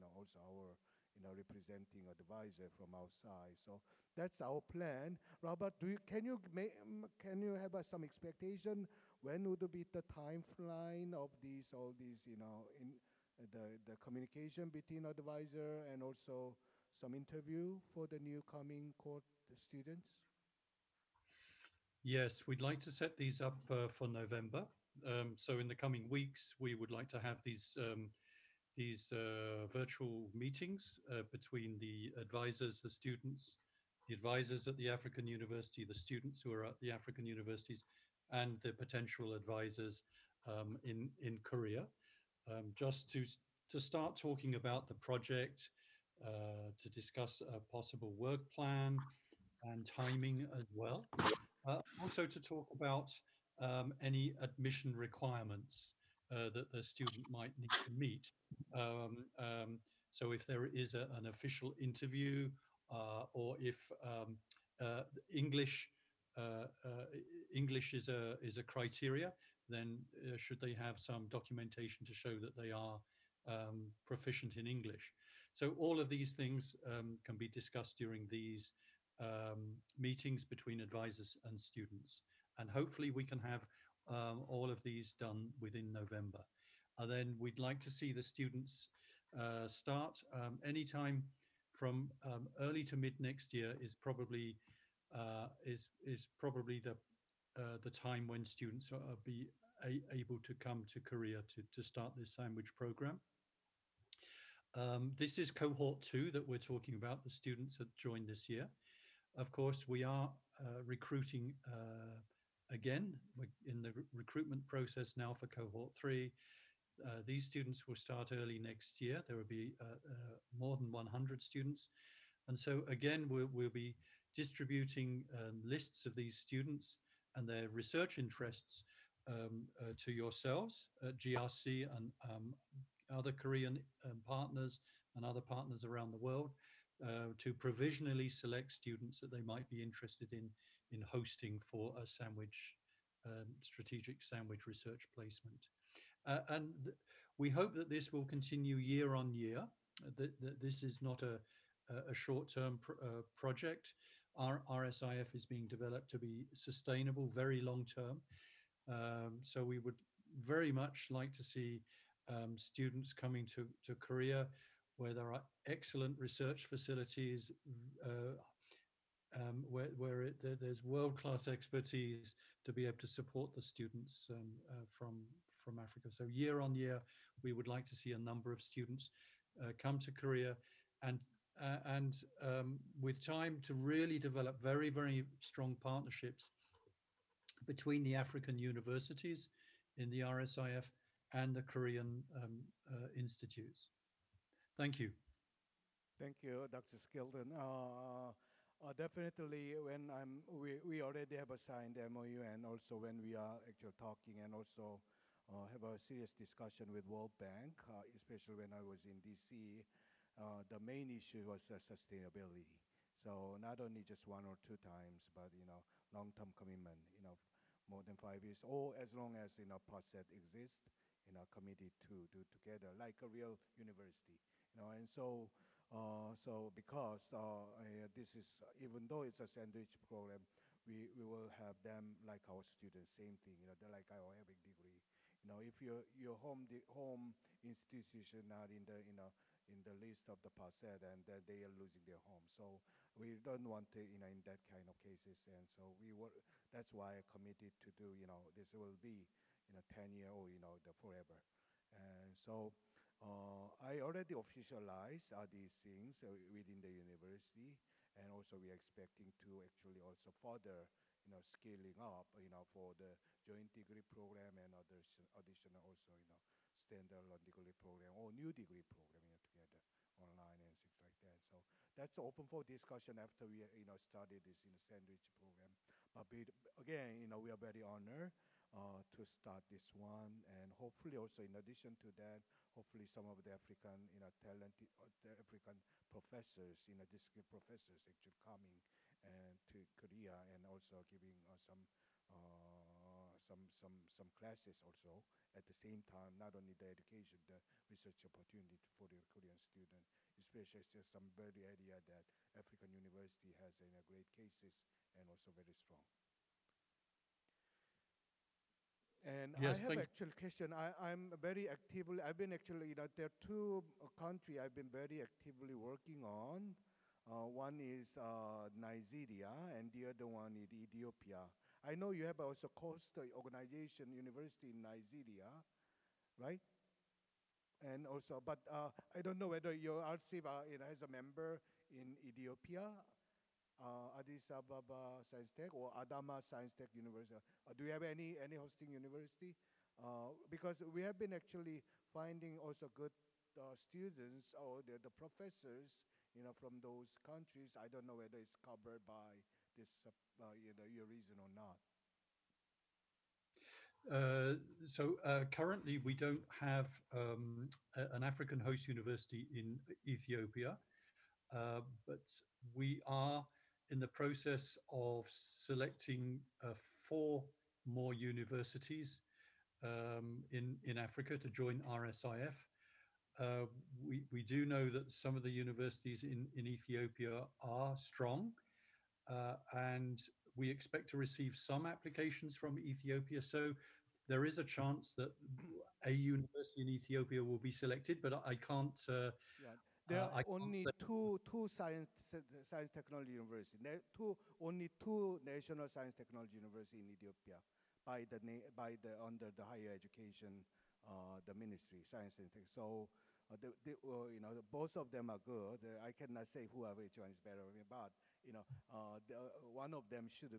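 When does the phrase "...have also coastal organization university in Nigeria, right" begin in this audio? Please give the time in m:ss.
5:22.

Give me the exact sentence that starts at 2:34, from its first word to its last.
Our RSIF is being developed to be sustainable, very long-term.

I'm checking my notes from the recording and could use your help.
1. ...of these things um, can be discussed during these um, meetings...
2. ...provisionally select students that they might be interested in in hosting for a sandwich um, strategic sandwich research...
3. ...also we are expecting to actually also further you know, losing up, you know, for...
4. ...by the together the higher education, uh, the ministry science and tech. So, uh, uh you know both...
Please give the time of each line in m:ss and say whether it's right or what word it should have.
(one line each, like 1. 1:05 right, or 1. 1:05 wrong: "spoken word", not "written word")
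1. 1:15 right
2. 2:17 right
3. 4:18 wrong: "scaling", not "losing"
4. 6:38 wrong: "under", not "together".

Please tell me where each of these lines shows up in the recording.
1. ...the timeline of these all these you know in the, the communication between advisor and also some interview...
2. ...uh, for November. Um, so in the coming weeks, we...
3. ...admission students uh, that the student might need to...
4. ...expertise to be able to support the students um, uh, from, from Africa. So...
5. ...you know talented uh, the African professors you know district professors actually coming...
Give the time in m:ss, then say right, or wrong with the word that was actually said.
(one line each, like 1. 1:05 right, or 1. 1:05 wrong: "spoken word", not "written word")
1. 0:09 right
2. 0:23 right
3. 0:54 wrong: "requirements", not "students"
4. 2:51 right
5. 4:44 right.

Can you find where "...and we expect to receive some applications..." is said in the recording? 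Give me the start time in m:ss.
6:19.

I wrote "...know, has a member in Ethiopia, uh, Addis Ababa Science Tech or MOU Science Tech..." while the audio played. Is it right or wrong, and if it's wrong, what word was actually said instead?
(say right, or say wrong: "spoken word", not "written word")
wrong: "Adama", not "MOU".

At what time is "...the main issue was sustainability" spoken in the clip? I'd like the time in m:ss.
3:30.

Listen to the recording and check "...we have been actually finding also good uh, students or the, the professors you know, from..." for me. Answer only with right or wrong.
right.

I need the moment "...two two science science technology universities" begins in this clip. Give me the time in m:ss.
6:30.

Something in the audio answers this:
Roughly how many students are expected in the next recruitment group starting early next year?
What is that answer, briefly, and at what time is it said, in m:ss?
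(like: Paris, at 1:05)
more than 100, at 2:00.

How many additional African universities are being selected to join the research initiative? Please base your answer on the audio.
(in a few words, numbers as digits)
4.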